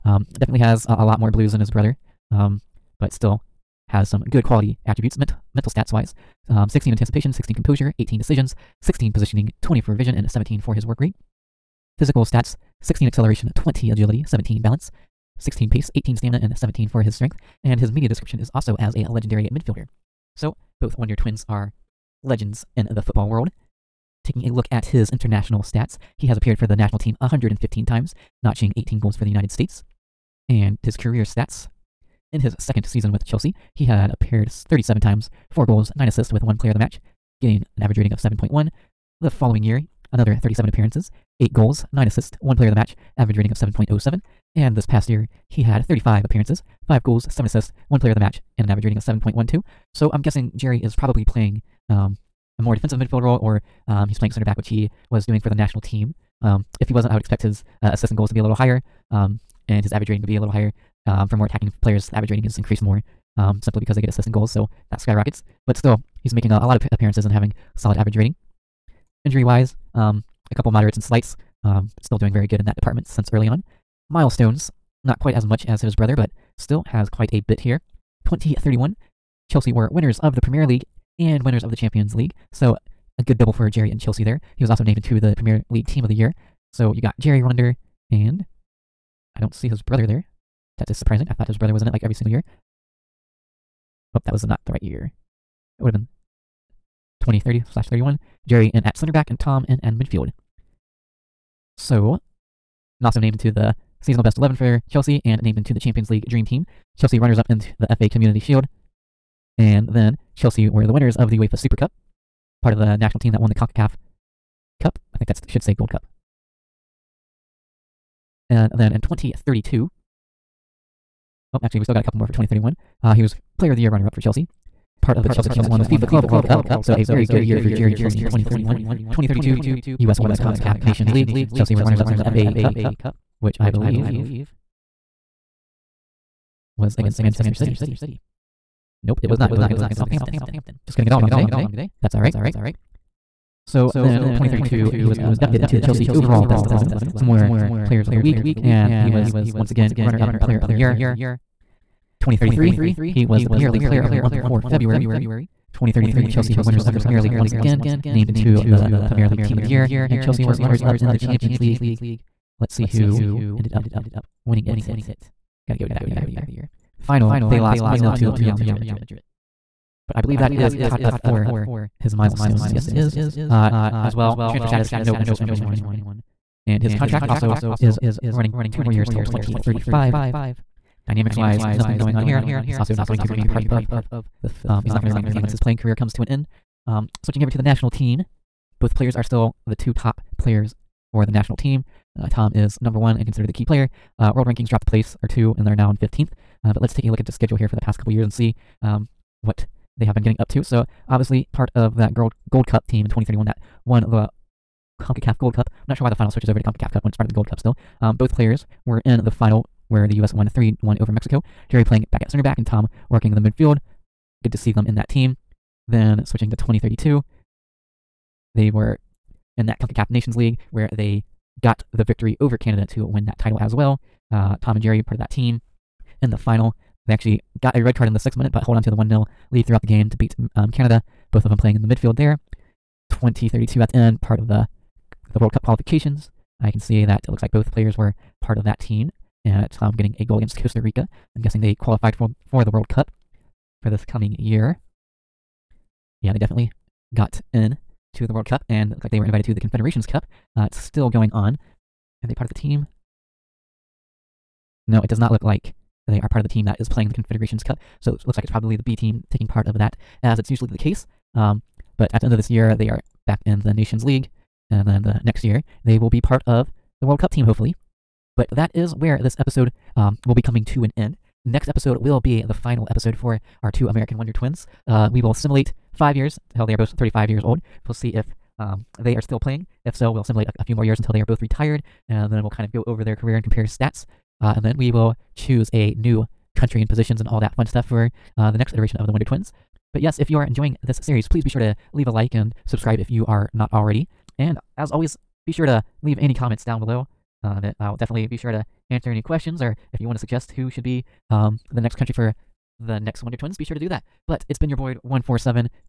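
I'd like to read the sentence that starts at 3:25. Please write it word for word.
I'm not sure why the final switches over to CONCACAF Cup when it's part of the Gold Cup still.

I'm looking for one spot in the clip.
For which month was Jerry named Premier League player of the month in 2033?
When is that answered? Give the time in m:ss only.
2:34.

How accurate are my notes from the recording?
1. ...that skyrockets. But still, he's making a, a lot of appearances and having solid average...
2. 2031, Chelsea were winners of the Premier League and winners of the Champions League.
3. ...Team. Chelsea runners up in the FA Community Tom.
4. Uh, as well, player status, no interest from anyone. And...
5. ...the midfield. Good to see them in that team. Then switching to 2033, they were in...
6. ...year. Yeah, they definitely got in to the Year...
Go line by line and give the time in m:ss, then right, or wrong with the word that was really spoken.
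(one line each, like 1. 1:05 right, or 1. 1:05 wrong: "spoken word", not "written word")
1. 1:04 right
2. 1:18 right
3. 1:46 wrong: "Shield", not "Tom"
4. 2:53 wrong: "transfer", not "player"
5. 3:33 wrong: "2032", not "2033"
6. 4:04 wrong: "World", not "Year".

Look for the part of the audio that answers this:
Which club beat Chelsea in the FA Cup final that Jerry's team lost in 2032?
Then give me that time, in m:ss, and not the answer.
2:19.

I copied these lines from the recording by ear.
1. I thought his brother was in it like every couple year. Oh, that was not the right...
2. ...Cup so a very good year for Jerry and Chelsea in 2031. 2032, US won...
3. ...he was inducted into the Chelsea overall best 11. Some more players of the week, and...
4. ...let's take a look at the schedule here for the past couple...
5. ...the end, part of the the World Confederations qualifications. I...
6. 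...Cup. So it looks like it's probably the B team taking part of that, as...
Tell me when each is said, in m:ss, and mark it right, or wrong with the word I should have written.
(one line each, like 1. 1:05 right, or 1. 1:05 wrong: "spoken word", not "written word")
1. 1:31 wrong: "single", not "couple"
2. 2:06 right
3. 2:24 right
4. 3:16 right
5. 3:53 wrong: "Cup", not "Confederations"
6. 4:17 right.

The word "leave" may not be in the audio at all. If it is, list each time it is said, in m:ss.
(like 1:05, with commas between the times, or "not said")
4:51, 4:56.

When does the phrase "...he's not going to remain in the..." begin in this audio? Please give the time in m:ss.
3:04.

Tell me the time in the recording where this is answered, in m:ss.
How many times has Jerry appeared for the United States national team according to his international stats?
0:27.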